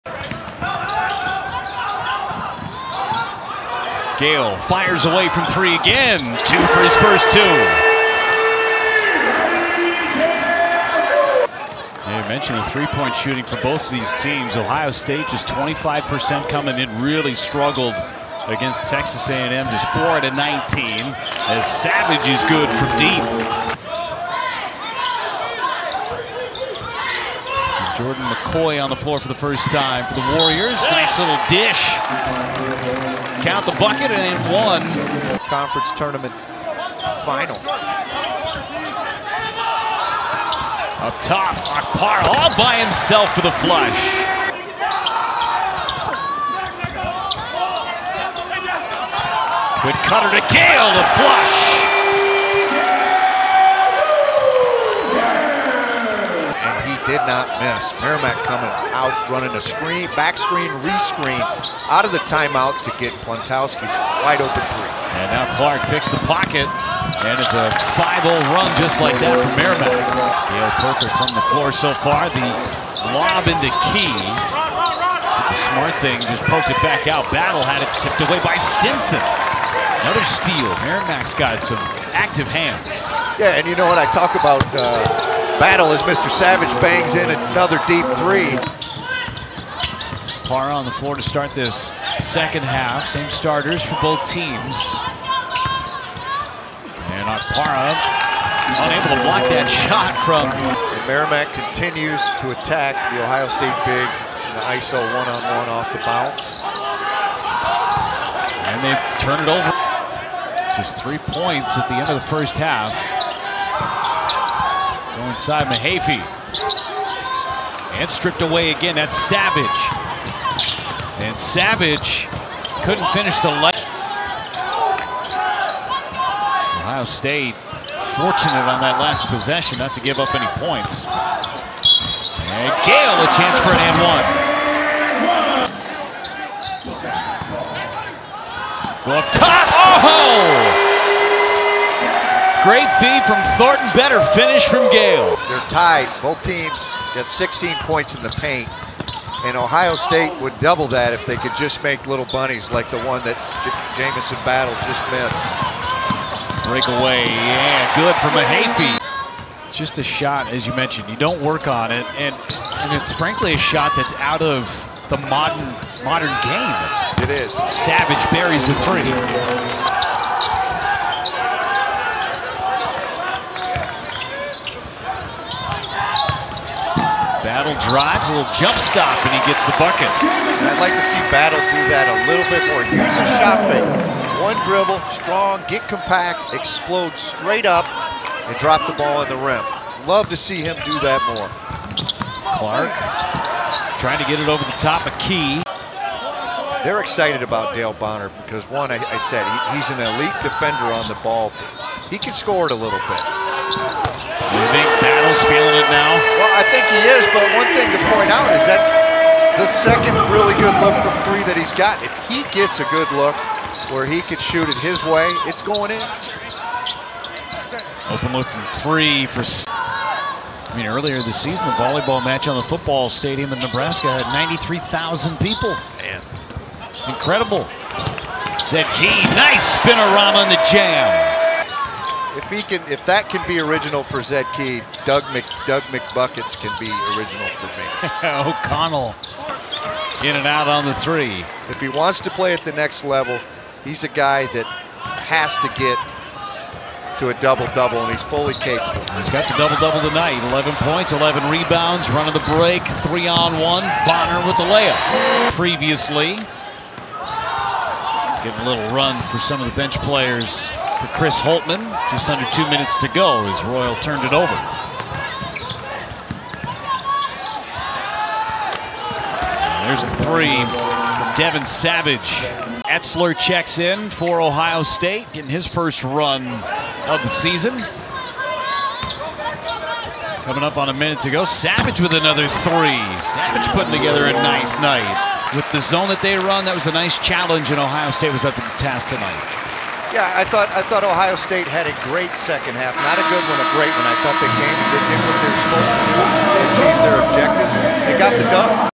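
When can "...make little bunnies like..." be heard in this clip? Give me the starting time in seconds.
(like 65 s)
151 s.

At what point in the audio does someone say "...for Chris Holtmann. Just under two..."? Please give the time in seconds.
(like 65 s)
261 s.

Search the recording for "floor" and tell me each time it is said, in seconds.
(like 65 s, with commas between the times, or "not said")
28 s, 71 s, 90 s.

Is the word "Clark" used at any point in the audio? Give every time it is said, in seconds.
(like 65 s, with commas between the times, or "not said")
65 s, 192 s.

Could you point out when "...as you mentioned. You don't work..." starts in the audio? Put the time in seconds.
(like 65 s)
160 s.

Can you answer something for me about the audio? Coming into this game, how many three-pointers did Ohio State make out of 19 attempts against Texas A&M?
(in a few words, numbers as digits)
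4.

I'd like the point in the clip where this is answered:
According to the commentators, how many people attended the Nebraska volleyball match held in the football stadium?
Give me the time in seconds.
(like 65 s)
224 s.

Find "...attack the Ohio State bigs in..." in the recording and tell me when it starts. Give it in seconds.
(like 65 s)
102 s.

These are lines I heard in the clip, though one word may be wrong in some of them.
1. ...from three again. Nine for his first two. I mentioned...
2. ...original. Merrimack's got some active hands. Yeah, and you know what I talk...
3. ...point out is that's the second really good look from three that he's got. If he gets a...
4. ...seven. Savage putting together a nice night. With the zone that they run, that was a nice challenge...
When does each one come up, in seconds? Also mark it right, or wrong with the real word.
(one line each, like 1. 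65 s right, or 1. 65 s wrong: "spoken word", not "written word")
1. 5 s wrong: "Two", not "Nine"
2. 80 s wrong: "steal", not "original"
3. 208 s right
4. 282 s wrong: "three", not "seven".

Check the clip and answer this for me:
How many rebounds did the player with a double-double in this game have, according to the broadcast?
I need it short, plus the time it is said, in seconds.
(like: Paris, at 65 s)
11, at 251 s.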